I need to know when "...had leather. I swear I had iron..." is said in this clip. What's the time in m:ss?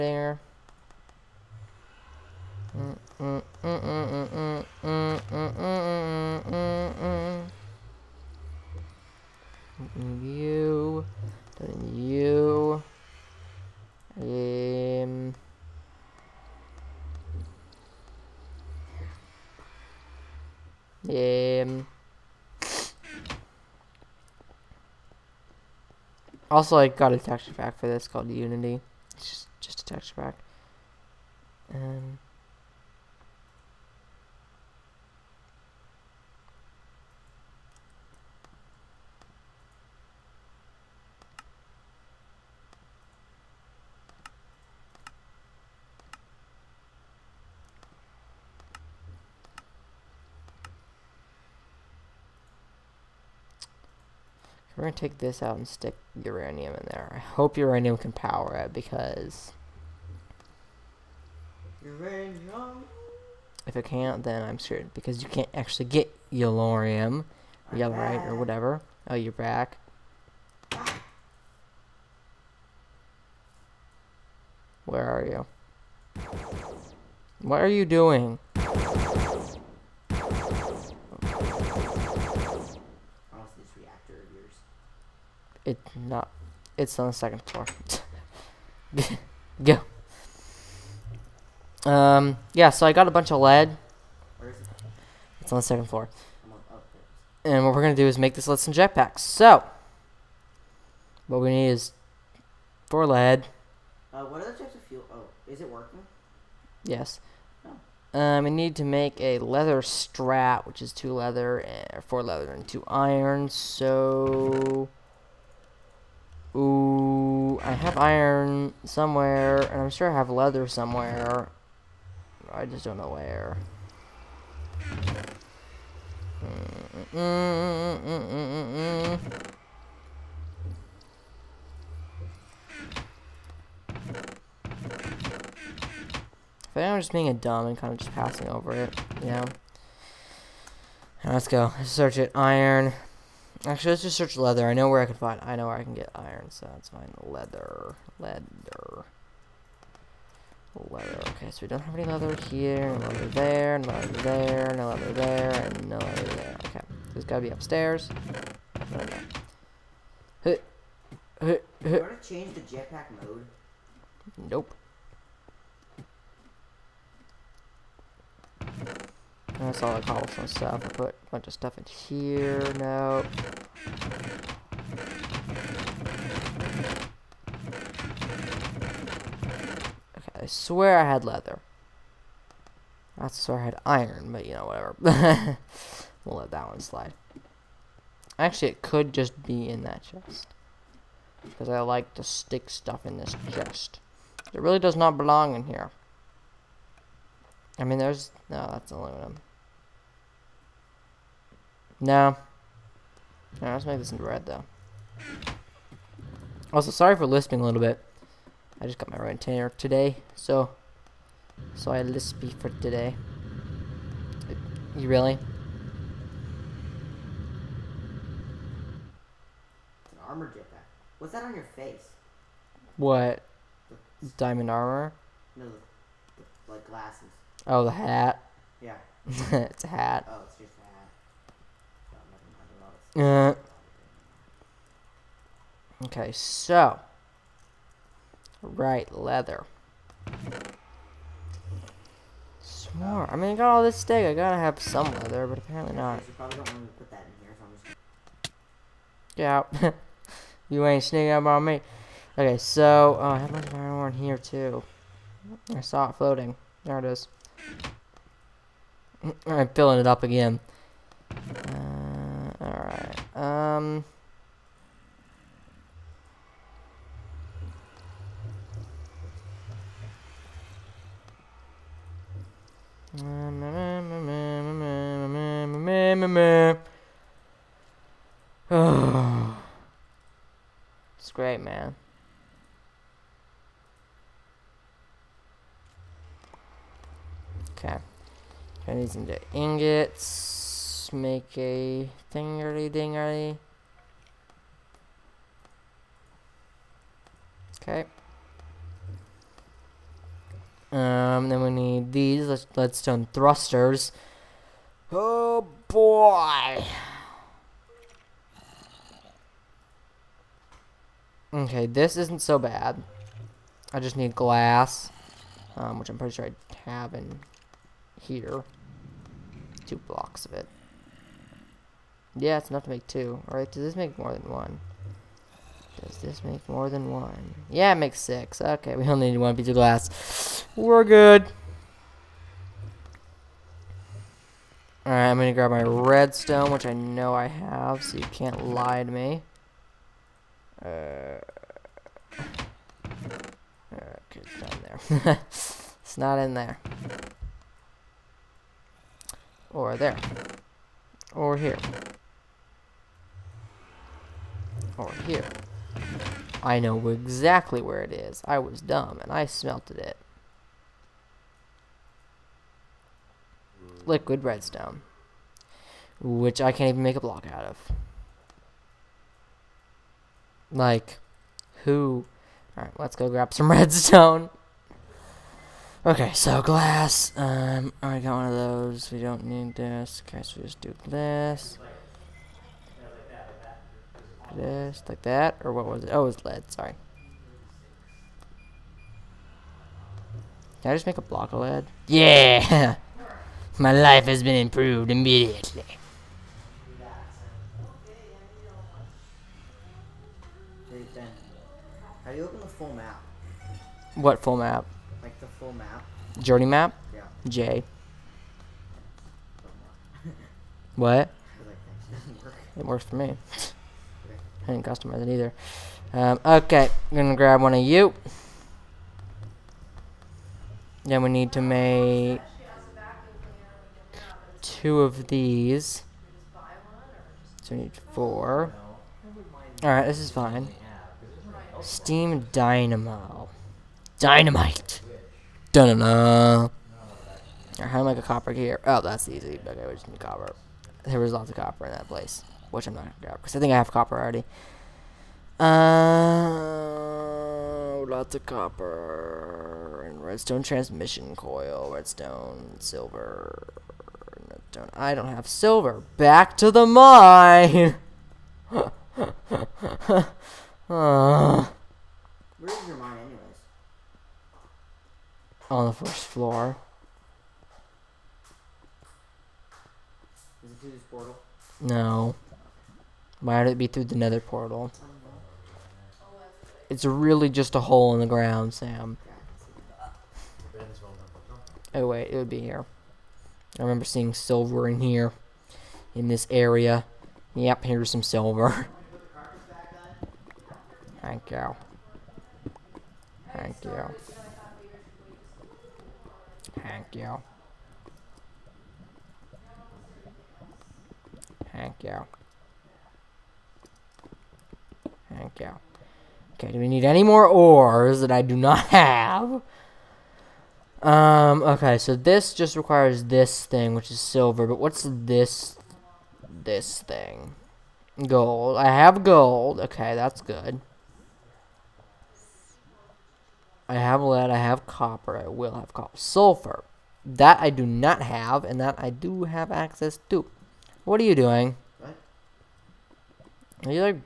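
3:01.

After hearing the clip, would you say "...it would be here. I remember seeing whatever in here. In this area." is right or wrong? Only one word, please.
wrong.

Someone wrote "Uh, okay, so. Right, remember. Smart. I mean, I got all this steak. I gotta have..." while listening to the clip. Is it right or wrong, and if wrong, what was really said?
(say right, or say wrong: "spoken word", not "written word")
wrong: "leather", not "remember".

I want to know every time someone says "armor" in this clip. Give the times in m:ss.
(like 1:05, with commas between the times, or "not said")
3:40, 3:44.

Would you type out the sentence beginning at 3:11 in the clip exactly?
Because I like to stick stuff in this chest.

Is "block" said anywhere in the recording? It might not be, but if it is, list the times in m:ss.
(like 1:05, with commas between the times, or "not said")
5:19, 6:07, 6:31.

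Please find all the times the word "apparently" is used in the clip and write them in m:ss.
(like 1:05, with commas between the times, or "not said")
4:05.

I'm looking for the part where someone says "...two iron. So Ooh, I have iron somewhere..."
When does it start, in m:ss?
1:52.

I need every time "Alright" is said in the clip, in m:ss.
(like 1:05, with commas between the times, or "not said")
5:23, 5:35, 6:12, 7:09, 7:16.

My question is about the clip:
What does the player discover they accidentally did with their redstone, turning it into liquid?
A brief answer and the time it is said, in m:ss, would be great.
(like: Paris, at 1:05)
Smelted it, at 5:59.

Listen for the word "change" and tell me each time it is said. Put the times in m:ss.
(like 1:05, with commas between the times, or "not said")
2:42.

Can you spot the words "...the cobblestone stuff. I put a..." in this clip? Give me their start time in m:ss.
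2:49.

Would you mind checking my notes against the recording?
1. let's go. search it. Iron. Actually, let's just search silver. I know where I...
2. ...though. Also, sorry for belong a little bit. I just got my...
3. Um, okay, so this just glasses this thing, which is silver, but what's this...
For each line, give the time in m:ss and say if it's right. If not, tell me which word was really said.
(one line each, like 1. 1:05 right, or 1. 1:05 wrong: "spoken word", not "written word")
1. 2:21 wrong: "leather", not "silver"
2. 3:24 wrong: "lisping", not "belong"
3. 8:31 wrong: "requires", not "glasses".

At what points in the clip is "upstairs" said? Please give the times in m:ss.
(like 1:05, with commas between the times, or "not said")
2:37.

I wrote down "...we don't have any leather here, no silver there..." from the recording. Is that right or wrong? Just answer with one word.
wrong.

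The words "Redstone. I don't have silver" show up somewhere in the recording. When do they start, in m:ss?
7:34.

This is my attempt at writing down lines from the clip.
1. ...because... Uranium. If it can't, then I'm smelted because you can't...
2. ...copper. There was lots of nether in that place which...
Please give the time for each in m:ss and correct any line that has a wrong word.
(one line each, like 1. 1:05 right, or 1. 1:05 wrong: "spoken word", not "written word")
1. 0:58 wrong: "screwed", not "smelted"
2. 7:20 wrong: "copper", not "nether".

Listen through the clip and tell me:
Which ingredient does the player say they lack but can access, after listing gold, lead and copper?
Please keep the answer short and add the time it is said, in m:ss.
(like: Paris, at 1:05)
Sulfur, at 8:46.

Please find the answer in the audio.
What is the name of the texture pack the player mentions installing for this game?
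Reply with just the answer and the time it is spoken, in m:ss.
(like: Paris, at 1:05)
Unity, at 0:28.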